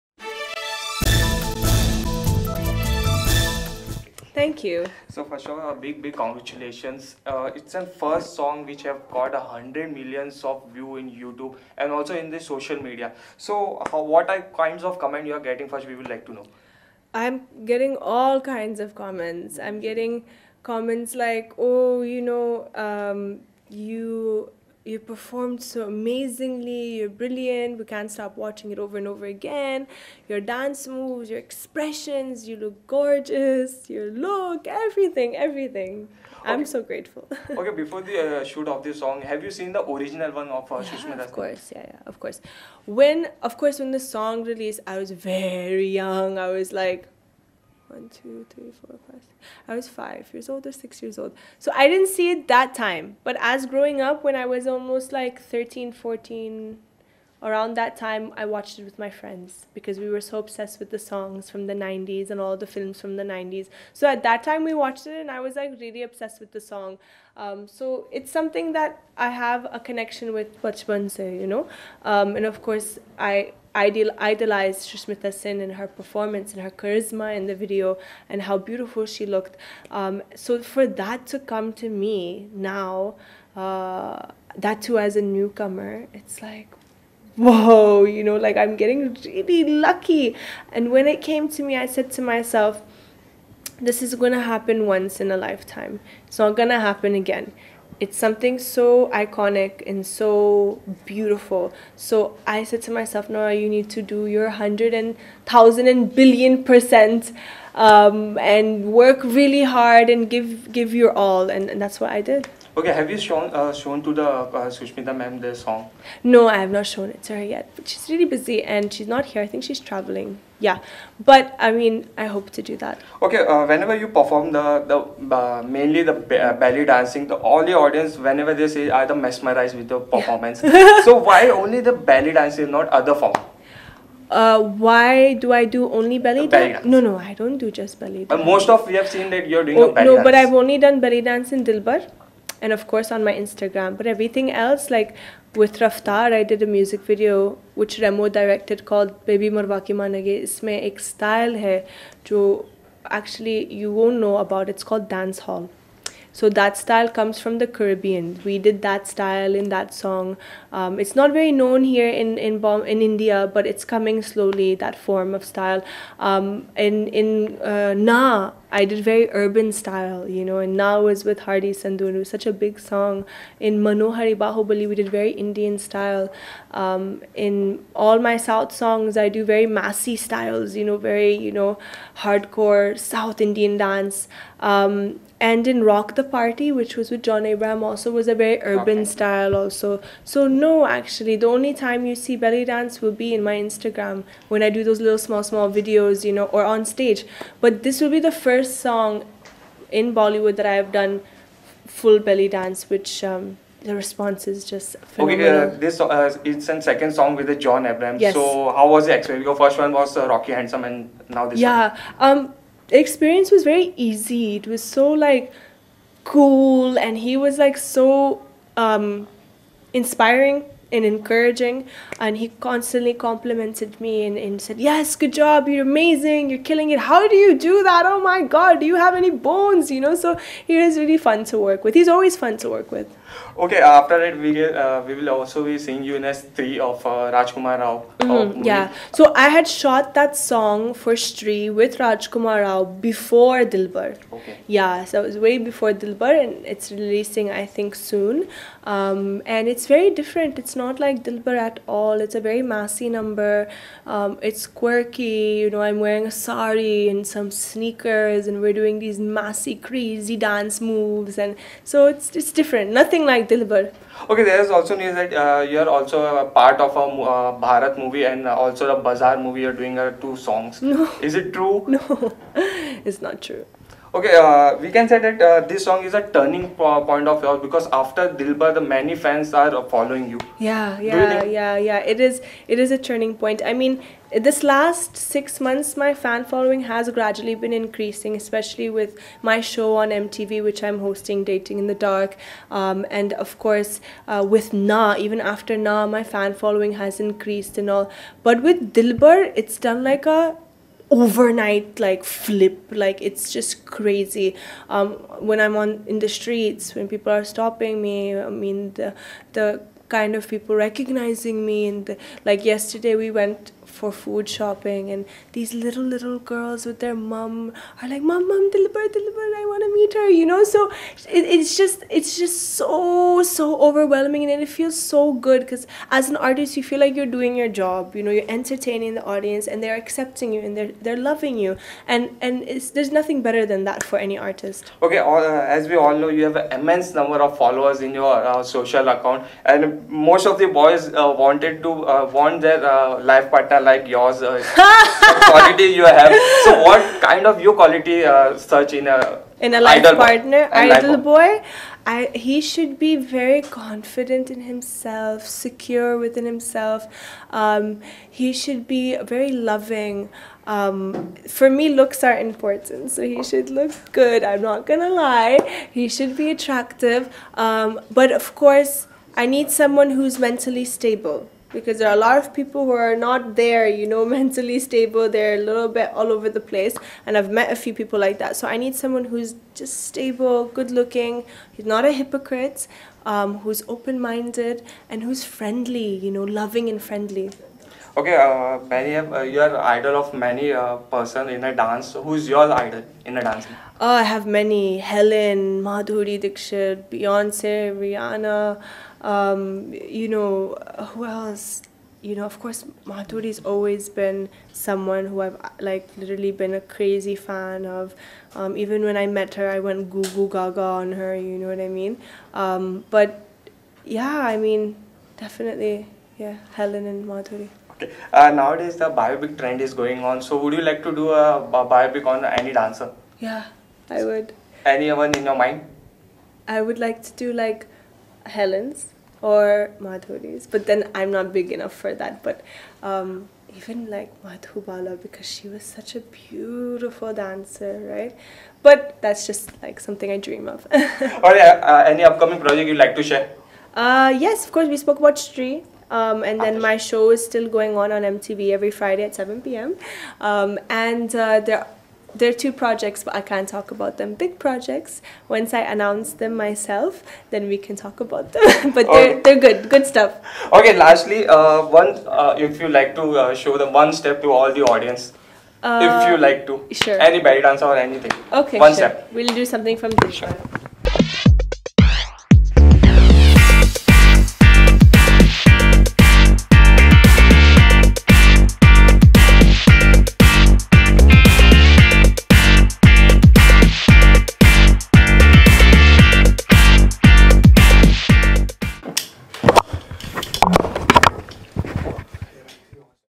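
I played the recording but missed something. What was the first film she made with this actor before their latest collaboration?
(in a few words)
Rocky Handsome.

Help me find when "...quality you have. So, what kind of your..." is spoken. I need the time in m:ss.
5:45.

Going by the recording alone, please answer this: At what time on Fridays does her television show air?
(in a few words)
7 p.m.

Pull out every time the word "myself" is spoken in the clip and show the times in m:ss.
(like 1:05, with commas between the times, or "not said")
1:32, 1:42, 7:36.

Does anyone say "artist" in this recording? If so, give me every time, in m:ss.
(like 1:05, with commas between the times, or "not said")
5:26, 5:34.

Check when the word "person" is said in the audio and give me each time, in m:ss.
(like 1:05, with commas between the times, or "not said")
6:30.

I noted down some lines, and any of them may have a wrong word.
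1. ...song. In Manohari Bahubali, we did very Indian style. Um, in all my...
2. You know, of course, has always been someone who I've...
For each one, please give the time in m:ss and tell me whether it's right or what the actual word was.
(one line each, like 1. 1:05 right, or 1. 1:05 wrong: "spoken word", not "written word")
1. 2:52 right
2. 6:42 right.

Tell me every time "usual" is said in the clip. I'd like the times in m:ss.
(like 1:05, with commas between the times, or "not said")
not said.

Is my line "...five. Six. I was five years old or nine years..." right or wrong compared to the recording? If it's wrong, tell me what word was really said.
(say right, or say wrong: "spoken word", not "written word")
wrong: "six", not "nine".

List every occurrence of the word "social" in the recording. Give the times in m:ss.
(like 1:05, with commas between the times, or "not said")
0:12, 5:38.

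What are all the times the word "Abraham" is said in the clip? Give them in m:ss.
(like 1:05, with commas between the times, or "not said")
3:07, 3:27.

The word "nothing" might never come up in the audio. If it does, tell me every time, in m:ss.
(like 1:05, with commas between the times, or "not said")
4:22, 5:33.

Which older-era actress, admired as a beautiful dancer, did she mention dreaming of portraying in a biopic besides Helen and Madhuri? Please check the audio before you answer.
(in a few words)
Madhubala.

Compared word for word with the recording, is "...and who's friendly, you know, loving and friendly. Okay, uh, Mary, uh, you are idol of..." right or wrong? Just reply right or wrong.
right.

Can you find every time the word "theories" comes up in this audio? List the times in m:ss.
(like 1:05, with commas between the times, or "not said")
not said.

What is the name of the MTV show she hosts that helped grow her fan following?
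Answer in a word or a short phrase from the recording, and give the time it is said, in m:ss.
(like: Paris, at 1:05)
Dating in the Dark, at 4:51.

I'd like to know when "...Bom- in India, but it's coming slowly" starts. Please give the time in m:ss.
2:42.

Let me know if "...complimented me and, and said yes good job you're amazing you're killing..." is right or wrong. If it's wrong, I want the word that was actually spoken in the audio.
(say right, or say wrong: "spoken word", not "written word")
right.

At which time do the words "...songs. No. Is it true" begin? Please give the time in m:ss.
4:30.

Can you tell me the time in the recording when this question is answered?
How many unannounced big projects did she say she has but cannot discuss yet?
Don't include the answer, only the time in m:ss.
7:32.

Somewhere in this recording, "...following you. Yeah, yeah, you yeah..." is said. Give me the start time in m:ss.
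4:39.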